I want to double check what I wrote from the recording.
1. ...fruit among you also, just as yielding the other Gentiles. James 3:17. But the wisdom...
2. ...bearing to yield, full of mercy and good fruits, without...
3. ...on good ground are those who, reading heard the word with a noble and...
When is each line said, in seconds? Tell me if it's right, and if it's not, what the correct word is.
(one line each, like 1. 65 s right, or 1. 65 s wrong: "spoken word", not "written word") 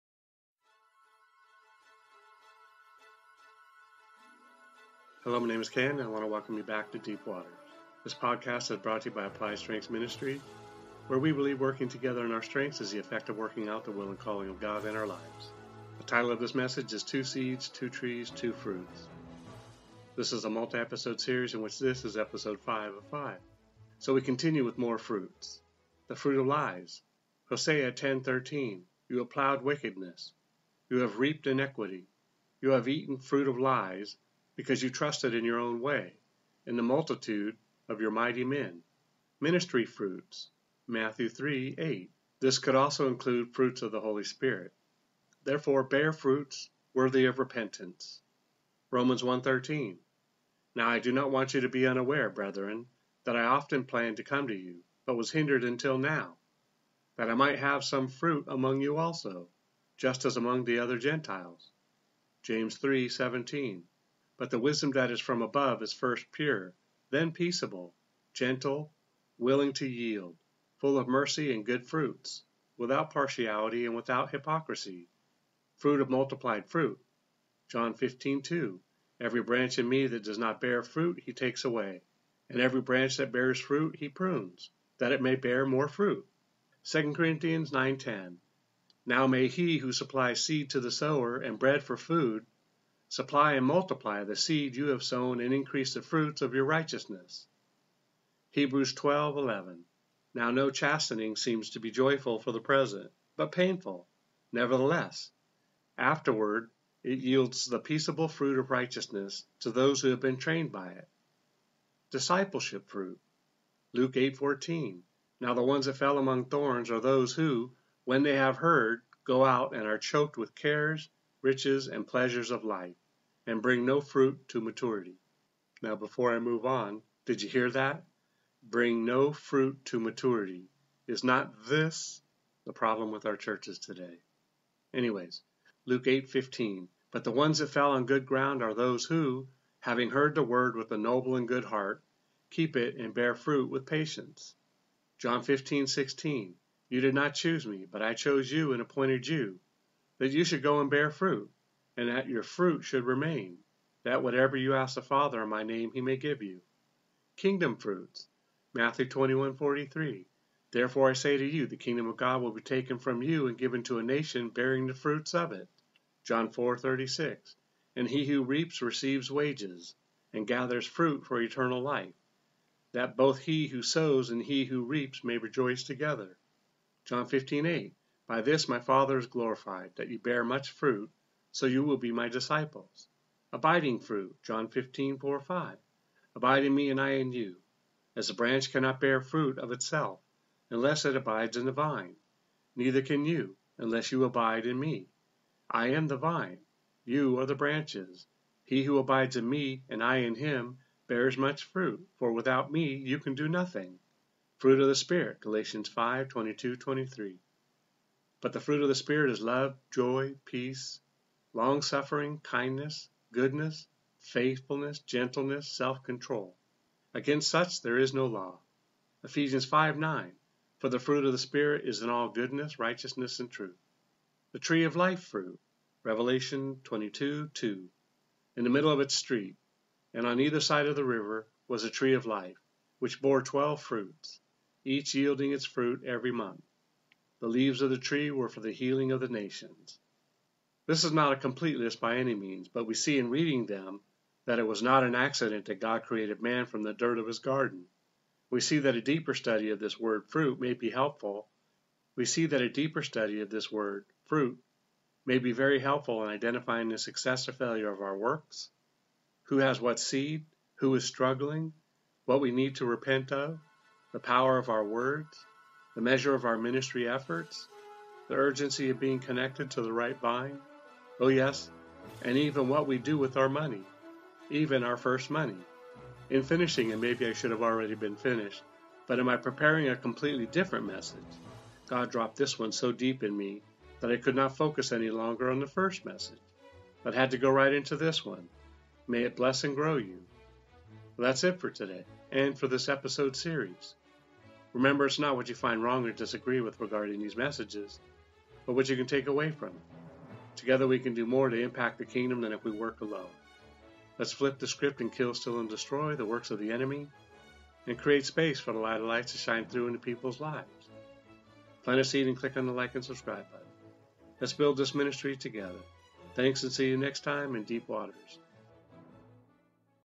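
1. 58 s wrong: "among", not "yielding"
2. 69 s wrong: "willing", not "bearing"
3. 137 s wrong: "having", not "reading".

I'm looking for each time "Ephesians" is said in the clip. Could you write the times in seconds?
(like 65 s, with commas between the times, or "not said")
219 s.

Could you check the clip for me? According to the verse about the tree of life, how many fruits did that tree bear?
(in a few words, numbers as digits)
12.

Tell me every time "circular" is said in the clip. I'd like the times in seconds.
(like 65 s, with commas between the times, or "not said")
not said.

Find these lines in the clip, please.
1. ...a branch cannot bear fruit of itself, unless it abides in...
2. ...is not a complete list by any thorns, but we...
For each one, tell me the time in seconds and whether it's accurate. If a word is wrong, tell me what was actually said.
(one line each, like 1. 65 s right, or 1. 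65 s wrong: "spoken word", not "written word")
1. 188 s right
2. 241 s wrong: "means", not "thorns".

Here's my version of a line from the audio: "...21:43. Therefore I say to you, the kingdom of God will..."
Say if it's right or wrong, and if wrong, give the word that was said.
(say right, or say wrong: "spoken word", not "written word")
right.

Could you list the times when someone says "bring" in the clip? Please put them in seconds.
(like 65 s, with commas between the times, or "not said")
123 s, 128 s.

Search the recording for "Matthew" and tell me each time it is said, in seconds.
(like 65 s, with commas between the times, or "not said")
40 s, 158 s.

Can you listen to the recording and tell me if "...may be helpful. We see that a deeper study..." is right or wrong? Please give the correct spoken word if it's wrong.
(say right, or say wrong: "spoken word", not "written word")
right.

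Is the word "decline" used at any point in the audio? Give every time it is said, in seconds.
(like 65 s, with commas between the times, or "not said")
not said.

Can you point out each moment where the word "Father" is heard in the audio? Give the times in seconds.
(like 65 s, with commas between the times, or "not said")
155 s, 178 s.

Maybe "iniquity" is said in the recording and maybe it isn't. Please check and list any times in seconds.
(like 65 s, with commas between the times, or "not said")
31 s.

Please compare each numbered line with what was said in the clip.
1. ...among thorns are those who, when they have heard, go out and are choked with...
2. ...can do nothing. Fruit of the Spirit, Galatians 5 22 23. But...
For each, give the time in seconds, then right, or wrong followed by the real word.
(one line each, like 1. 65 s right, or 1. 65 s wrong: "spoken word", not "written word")
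1. 116 s right
2. 203 s right.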